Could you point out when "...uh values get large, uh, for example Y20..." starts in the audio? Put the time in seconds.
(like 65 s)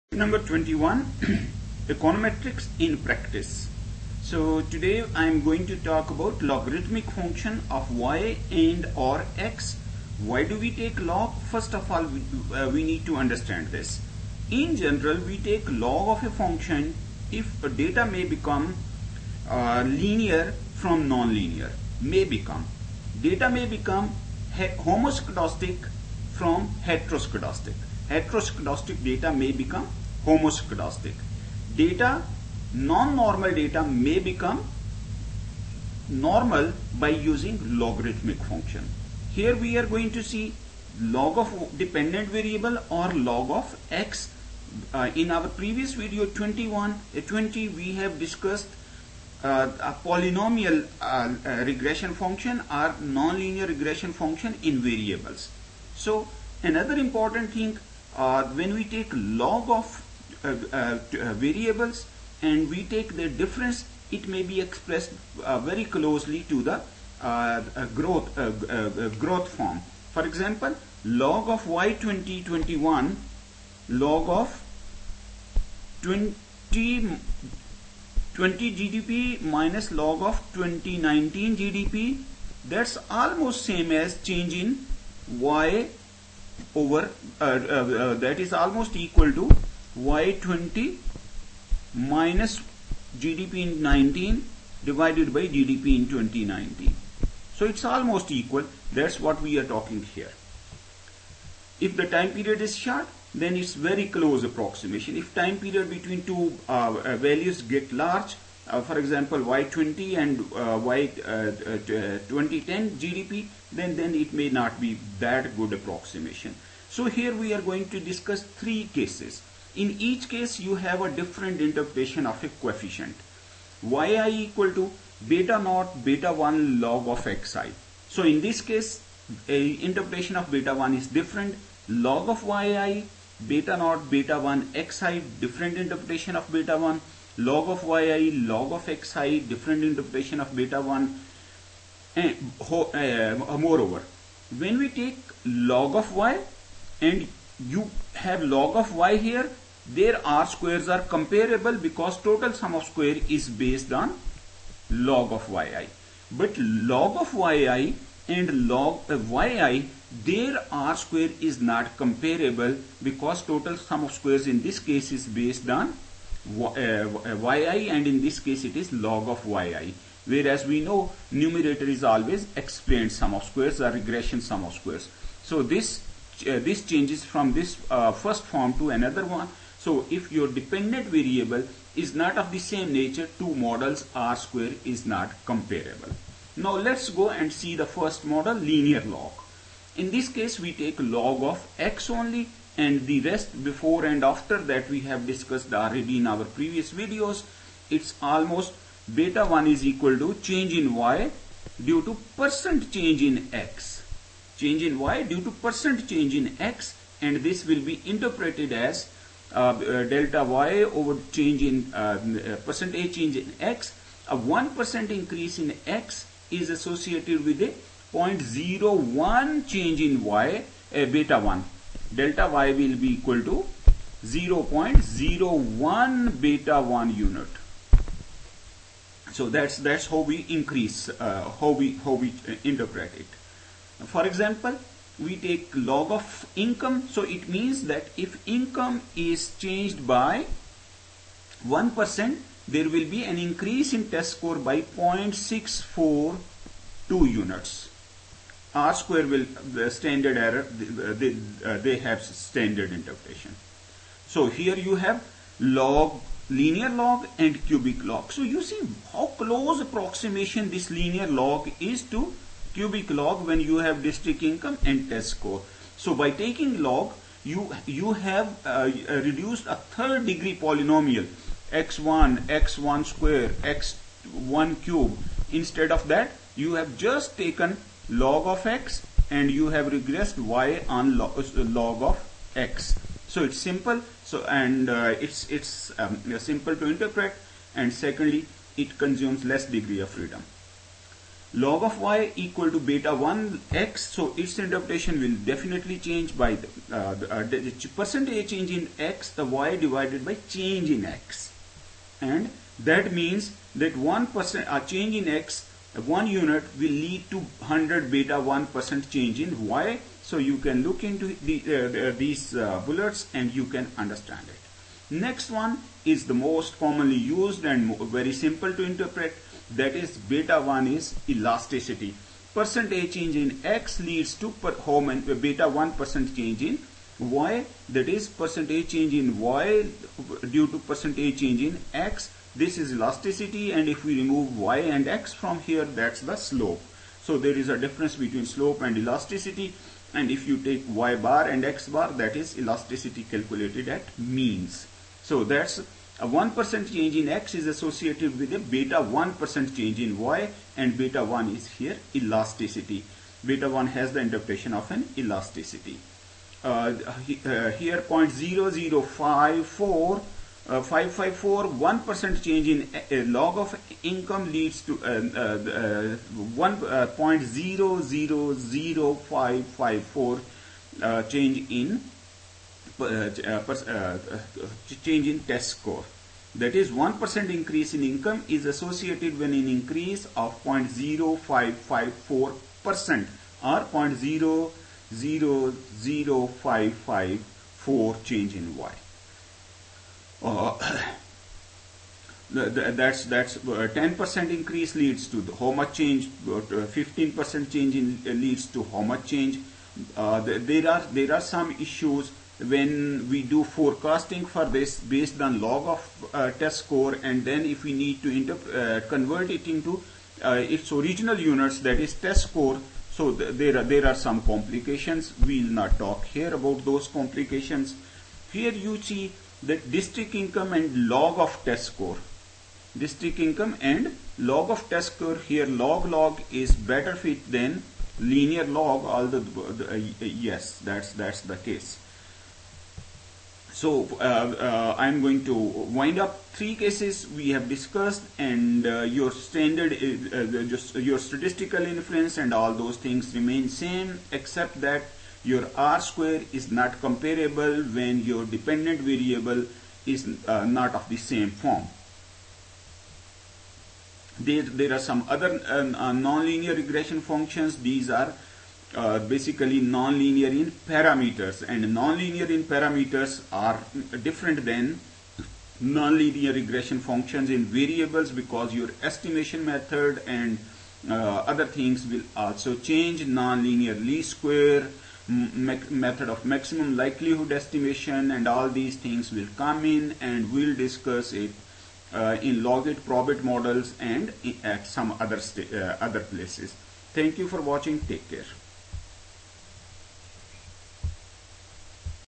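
107 s.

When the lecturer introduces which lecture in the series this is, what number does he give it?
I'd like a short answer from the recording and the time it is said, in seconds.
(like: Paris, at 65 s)
21, at 0 s.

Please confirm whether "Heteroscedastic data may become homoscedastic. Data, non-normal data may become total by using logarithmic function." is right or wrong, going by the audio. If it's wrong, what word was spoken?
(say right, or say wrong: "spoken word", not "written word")
wrong: "normal", not "total".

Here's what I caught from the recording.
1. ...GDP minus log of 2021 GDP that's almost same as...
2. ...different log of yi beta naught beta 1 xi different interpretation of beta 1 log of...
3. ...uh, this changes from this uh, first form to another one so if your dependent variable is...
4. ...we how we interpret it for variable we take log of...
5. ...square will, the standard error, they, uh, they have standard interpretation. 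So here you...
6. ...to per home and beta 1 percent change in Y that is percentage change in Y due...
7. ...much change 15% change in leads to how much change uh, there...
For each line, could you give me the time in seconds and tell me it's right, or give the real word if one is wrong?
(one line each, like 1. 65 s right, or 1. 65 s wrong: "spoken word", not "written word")
1. 78 s wrong: "2019", not "2021"
2. 131 s right
3. 176 s right
4. 231 s wrong: "example", not "variable"
5. 248 s right
6. 324 s right
7. 395 s right.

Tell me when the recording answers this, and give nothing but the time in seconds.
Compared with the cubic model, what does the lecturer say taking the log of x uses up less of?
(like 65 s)
289 s.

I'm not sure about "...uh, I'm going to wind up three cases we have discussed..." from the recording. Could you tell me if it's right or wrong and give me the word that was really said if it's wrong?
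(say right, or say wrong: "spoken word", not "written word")
right.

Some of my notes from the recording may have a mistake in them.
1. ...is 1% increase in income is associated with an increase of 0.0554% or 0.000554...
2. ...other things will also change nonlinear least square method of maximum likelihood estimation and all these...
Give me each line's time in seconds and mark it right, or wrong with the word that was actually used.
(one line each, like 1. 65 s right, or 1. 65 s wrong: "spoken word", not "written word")
1. 376 s right
2. 471 s right.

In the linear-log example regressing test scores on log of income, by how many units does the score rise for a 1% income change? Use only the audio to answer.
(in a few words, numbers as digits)
0.642.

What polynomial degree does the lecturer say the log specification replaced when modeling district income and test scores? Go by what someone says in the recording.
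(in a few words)
third degree.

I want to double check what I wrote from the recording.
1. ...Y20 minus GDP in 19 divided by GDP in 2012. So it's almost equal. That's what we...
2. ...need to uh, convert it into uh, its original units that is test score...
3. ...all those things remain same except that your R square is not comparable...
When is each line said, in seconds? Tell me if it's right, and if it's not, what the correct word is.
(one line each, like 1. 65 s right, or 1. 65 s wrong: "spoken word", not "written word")
1. 89 s wrong: "2019", not "2012"
2. 407 s right
3. 442 s right.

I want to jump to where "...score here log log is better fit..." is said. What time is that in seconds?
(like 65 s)
425 s.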